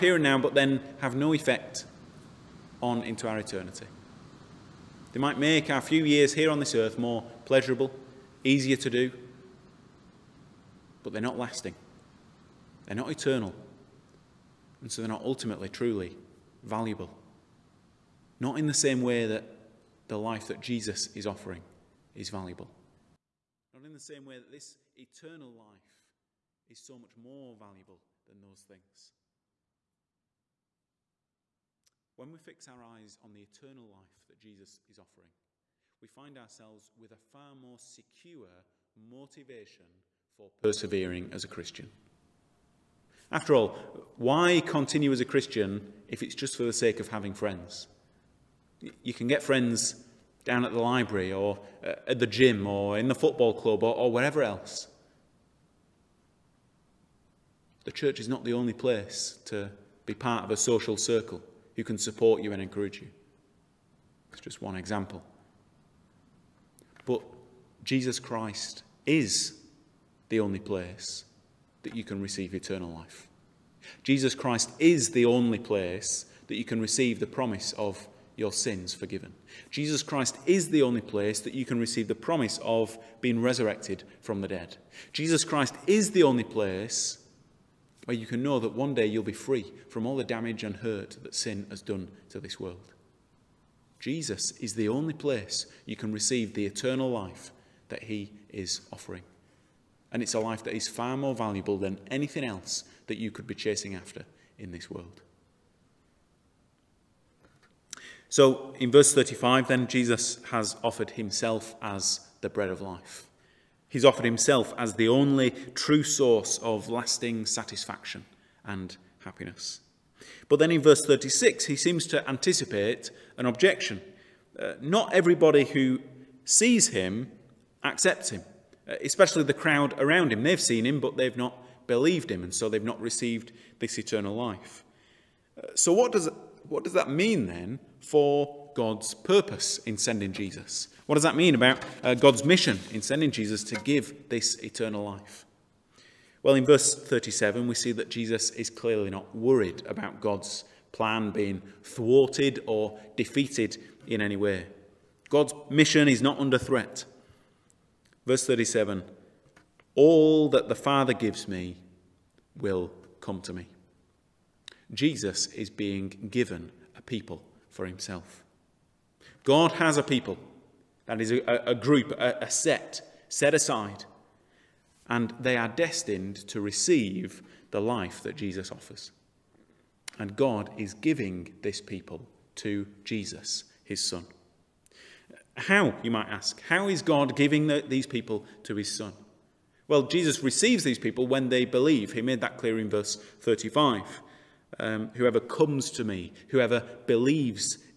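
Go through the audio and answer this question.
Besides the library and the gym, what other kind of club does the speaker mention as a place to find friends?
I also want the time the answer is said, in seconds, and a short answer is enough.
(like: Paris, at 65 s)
football club, at 53 s.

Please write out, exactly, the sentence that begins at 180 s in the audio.
And God is giving this people to Jesus, his son.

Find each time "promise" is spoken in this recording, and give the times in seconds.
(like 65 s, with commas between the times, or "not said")
77 s, 82 s.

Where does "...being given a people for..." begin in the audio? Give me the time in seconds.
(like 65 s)
165 s.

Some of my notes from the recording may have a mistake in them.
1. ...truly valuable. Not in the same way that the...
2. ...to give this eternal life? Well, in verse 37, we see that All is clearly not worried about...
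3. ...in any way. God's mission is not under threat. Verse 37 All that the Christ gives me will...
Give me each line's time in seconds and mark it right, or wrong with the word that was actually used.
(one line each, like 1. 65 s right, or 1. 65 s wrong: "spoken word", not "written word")
1. 15 s right
2. 143 s wrong: "Jesus", not "All"
3. 154 s wrong: "Father", not "Christ".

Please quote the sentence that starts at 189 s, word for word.
Well, Jesus receives these people when they believe.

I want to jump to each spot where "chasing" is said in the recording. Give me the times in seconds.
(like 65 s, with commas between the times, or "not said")
103 s.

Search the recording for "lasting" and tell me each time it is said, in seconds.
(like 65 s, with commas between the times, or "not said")
11 s, 116 s.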